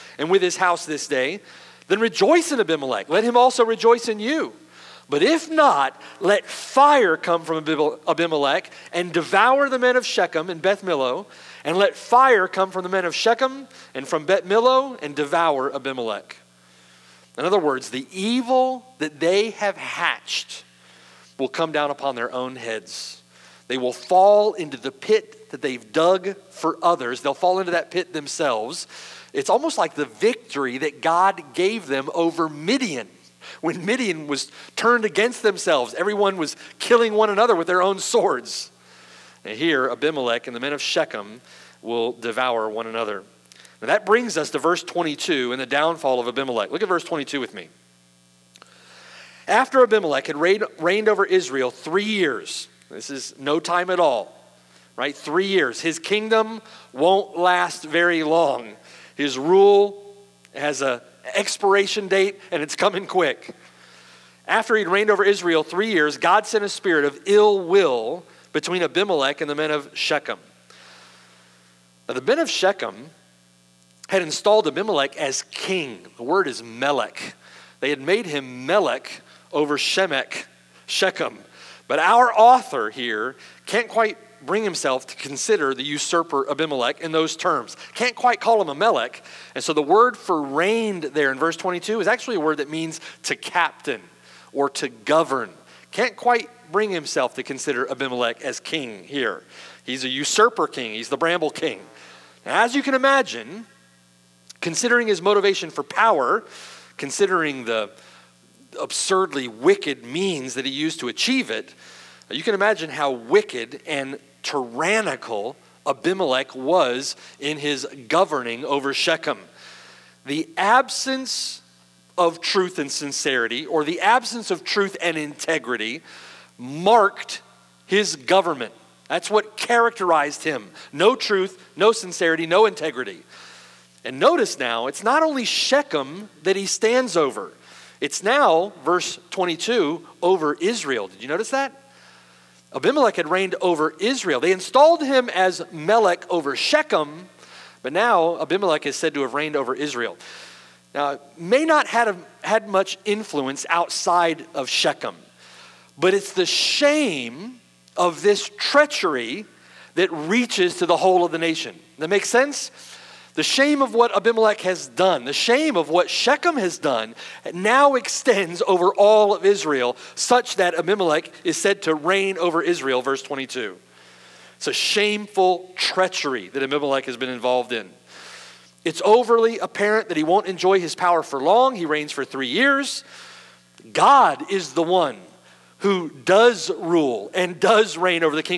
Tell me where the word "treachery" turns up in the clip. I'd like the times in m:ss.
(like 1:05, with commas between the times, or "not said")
2:38, 2:55.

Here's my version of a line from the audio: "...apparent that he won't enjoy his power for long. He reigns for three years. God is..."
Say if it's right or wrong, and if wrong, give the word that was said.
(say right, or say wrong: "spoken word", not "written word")
right.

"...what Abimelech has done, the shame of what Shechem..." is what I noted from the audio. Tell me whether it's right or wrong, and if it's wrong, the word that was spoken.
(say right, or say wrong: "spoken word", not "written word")
right.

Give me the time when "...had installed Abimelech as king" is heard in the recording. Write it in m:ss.
1:14.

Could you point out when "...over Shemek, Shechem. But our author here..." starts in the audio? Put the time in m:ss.
1:19.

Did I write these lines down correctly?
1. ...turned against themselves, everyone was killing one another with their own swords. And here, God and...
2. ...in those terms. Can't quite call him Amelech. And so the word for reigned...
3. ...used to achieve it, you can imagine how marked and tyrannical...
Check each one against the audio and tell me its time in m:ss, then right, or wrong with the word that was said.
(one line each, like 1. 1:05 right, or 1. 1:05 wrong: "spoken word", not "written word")
1. 0:34 wrong: "Abimelech", not "God"
2. 1:26 right
3. 1:50 wrong: "wicked", not "marked".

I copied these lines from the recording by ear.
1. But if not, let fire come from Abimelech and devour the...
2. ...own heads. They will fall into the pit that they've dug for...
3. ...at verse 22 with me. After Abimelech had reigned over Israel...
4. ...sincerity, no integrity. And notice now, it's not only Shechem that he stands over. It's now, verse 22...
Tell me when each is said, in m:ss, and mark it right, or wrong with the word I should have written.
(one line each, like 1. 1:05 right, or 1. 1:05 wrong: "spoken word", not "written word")
1. 0:05 right
2. 0:22 right
3. 0:46 right
4. 2:11 right.